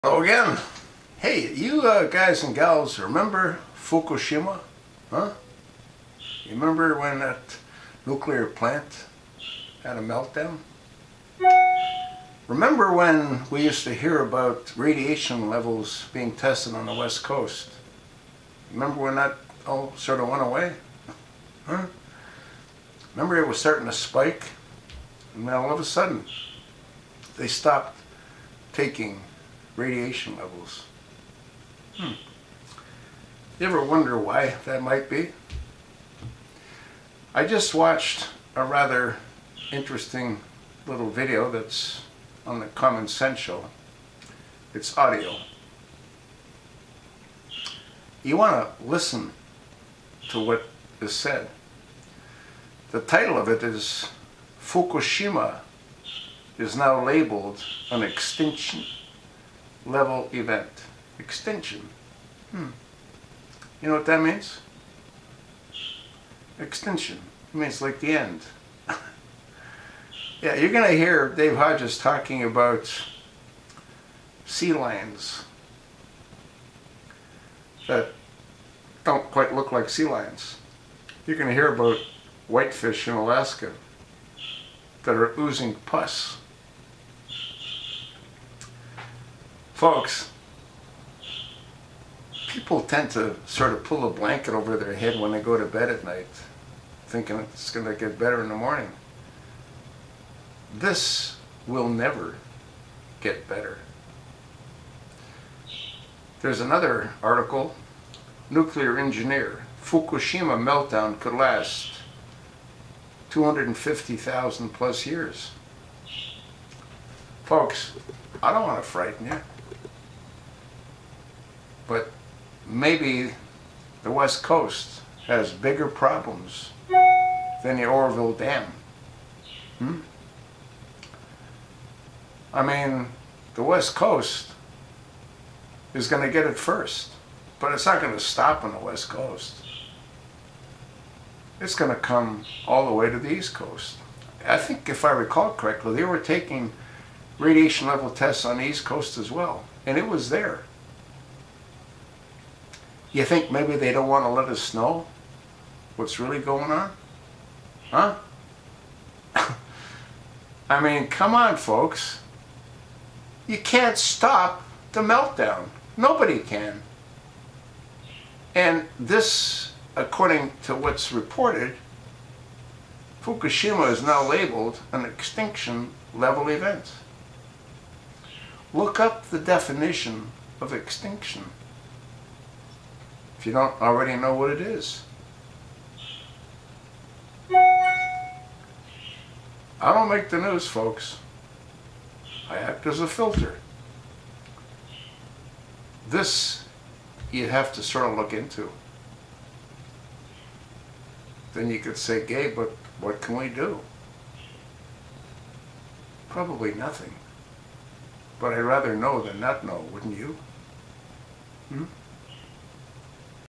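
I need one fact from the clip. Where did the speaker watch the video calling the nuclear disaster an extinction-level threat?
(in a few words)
The Common Sense Show.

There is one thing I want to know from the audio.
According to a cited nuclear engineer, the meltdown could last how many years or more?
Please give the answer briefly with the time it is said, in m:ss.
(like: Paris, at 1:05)
250,000, at 1:53.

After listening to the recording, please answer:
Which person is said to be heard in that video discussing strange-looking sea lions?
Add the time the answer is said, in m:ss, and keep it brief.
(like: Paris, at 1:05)
Dave Hodges, at 1:11.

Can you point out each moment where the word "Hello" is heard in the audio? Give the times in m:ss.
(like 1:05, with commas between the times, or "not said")
0:00.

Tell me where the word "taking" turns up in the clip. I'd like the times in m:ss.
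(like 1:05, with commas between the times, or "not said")
0:28, 2:26.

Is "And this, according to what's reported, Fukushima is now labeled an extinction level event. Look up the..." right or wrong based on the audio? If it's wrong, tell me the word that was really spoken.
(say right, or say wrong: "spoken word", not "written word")
right.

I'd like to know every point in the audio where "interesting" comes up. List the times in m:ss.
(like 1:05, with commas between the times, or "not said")
0:39.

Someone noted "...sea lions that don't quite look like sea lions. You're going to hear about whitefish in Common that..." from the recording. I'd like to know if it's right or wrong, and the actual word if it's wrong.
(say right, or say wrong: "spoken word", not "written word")
wrong: "Alaska", not "Common".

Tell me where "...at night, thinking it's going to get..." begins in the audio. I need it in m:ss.
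1:35.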